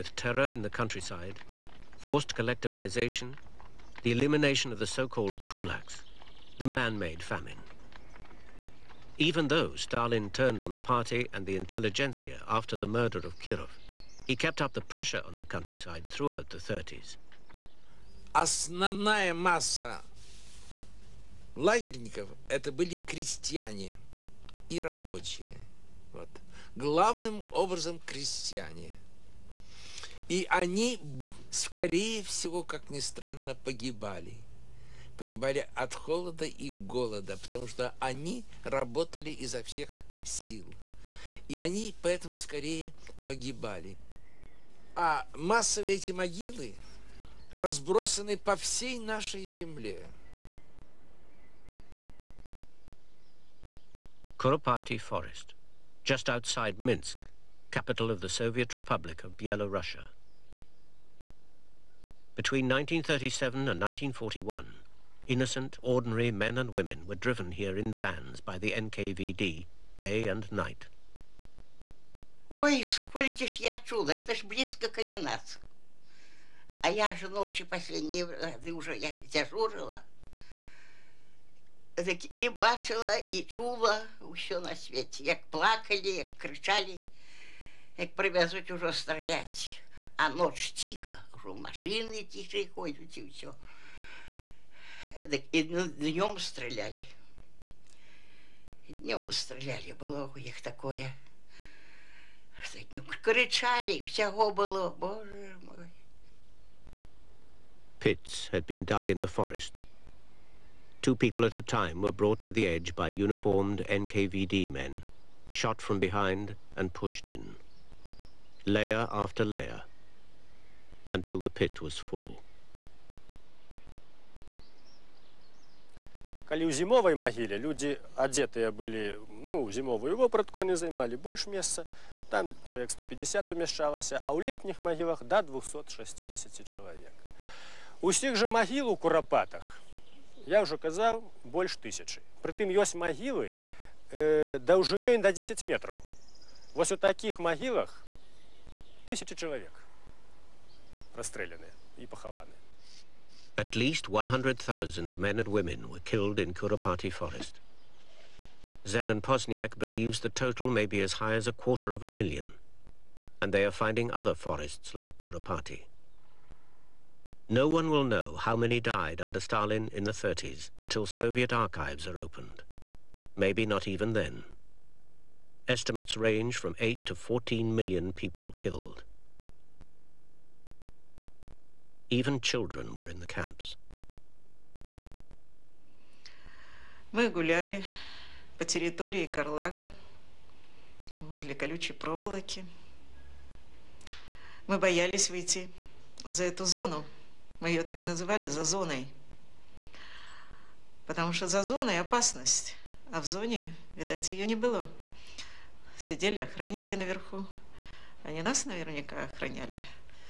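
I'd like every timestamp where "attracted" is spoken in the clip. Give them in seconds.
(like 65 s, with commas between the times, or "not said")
not said.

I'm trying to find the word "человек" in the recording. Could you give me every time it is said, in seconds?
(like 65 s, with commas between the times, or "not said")
132 s, 136 s, 149 s.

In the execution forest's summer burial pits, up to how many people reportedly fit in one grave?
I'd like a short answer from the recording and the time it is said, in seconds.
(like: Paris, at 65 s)
260, at 135 s.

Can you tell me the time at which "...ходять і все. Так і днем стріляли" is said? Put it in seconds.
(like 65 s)
92 s.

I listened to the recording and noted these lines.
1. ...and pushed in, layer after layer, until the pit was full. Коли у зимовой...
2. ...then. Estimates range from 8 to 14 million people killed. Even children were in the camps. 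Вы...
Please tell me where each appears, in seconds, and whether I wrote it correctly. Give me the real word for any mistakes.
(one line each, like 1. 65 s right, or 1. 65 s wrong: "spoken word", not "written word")
1. 116 s right
2. 174 s right.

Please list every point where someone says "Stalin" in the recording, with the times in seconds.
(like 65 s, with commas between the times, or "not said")
9 s, 169 s.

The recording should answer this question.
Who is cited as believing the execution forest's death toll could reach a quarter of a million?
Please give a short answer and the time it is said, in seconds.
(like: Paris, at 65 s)
Zenon Posniak, at 158 s.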